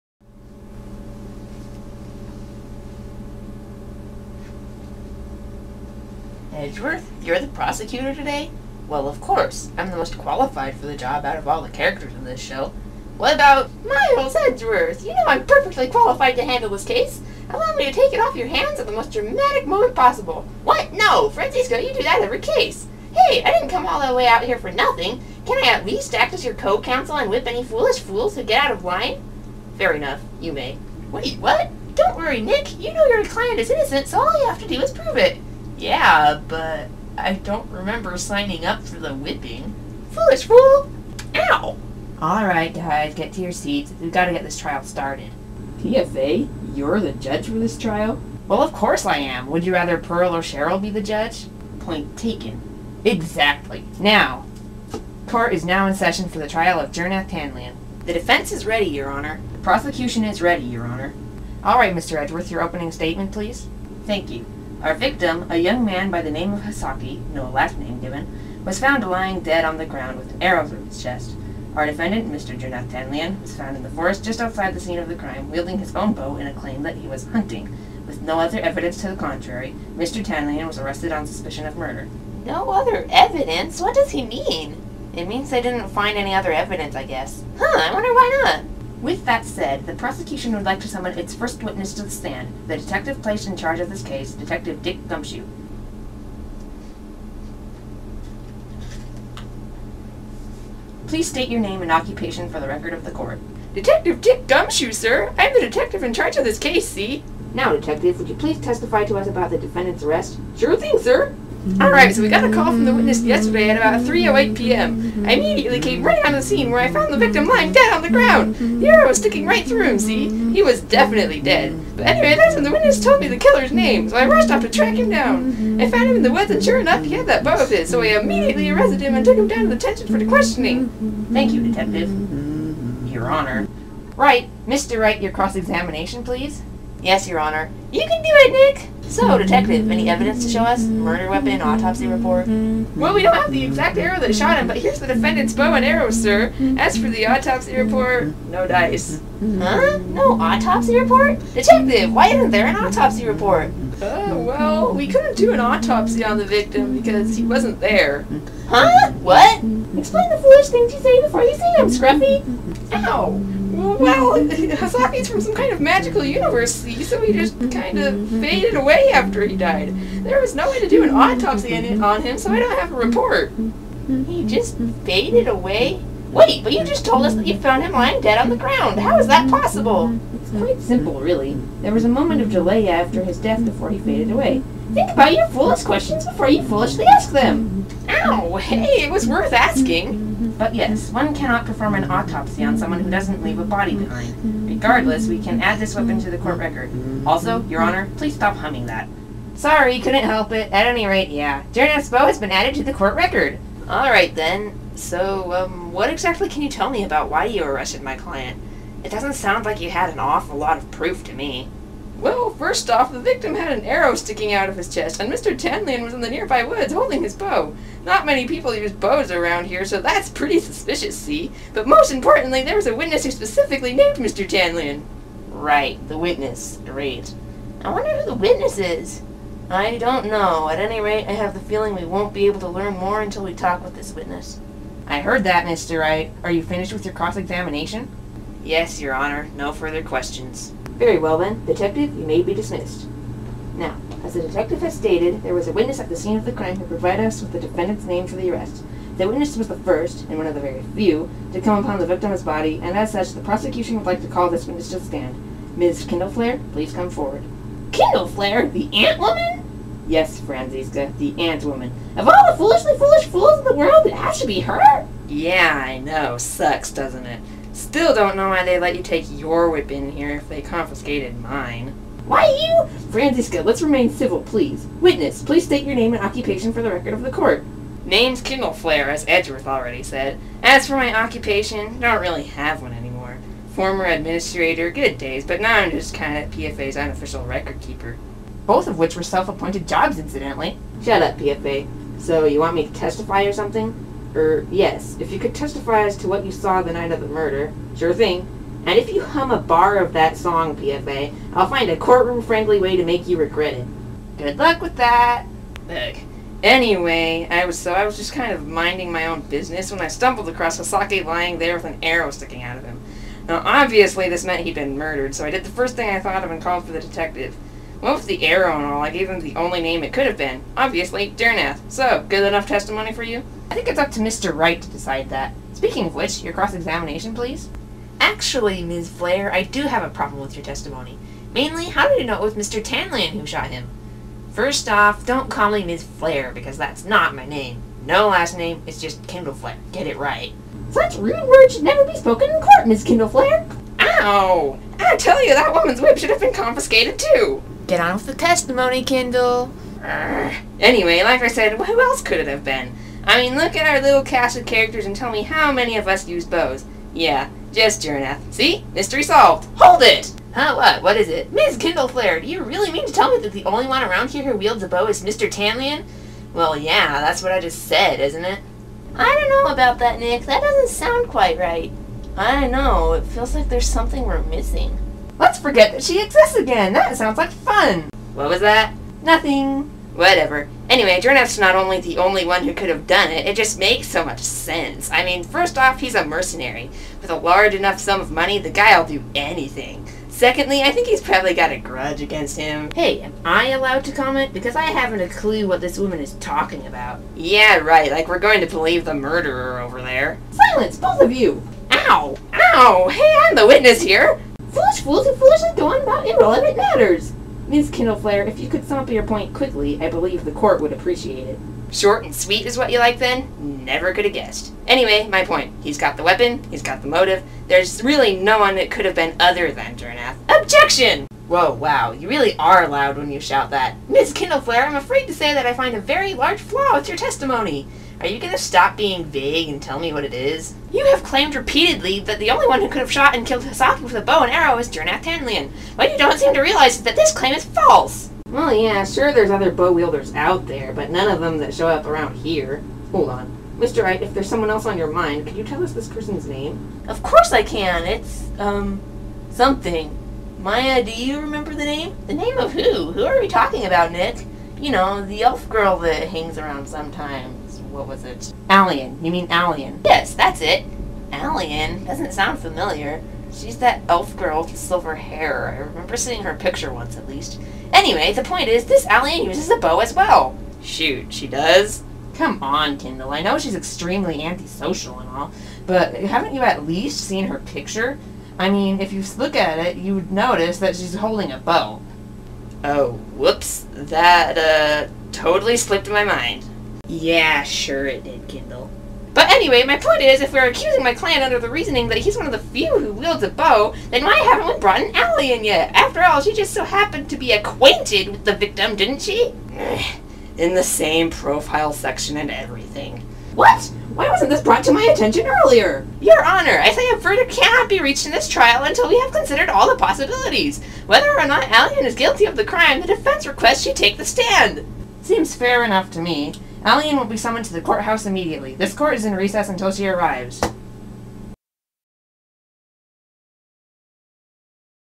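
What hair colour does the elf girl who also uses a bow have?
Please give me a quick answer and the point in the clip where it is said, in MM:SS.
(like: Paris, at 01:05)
Silver, at 07:44.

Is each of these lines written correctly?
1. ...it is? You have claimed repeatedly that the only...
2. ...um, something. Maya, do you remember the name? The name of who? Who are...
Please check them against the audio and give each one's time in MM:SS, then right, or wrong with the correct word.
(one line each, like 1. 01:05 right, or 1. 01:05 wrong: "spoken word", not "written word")
1. 07:10 right
2. 07:28 right.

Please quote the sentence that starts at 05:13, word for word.
Now obviously this meant he'd been murdered, so I did the first thing I thought of and called for the detective.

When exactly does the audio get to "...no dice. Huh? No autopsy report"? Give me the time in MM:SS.
02:28.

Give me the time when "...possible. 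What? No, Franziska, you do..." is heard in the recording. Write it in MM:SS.
00:19.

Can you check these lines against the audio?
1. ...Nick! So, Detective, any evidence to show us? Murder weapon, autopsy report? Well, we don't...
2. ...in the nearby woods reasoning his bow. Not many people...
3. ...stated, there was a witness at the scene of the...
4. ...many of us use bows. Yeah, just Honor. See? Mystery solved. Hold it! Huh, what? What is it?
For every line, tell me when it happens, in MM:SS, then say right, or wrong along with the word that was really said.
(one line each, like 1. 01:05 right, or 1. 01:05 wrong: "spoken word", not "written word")
1. 02:18 right
2. 03:36 wrong: "holding", not "reasoning"
3. 04:04 right
4. 05:55 wrong: "Jirnath", not "Honor".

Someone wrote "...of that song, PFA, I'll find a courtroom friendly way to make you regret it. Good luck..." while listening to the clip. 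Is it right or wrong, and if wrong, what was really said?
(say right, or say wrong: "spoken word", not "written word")
right.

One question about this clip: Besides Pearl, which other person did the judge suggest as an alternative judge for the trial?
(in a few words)
Cheryl.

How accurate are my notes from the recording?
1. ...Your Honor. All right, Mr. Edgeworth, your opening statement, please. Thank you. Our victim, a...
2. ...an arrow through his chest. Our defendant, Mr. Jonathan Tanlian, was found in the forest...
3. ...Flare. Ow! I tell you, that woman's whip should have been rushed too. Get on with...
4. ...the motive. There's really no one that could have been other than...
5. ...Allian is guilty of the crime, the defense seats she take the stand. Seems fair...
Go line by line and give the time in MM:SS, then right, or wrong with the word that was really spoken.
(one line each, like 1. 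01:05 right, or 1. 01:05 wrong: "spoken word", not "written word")
1. 01:00 right
2. 01:10 right
3. 05:43 wrong: "confiscated", not "rushed"
4. 06:57 right
5. 08:31 wrong: "requests", not "seats".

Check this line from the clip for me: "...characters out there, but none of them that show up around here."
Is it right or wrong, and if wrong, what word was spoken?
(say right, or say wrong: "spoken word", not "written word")
wrong: "wielders", not "characters".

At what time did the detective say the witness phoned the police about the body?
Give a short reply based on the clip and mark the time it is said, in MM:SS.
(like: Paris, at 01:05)
3:08 p.m., at 01:54.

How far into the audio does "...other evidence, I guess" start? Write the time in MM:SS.
01:26.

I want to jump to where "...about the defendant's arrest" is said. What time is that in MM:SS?
01:49.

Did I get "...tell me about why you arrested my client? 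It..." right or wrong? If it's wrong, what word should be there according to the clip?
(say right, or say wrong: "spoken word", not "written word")
right.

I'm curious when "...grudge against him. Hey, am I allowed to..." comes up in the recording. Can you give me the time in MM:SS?
06:31.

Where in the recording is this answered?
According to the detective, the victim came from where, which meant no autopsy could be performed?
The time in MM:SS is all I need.
02:45.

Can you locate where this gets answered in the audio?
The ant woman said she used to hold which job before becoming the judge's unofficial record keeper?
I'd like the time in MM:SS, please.
04:44.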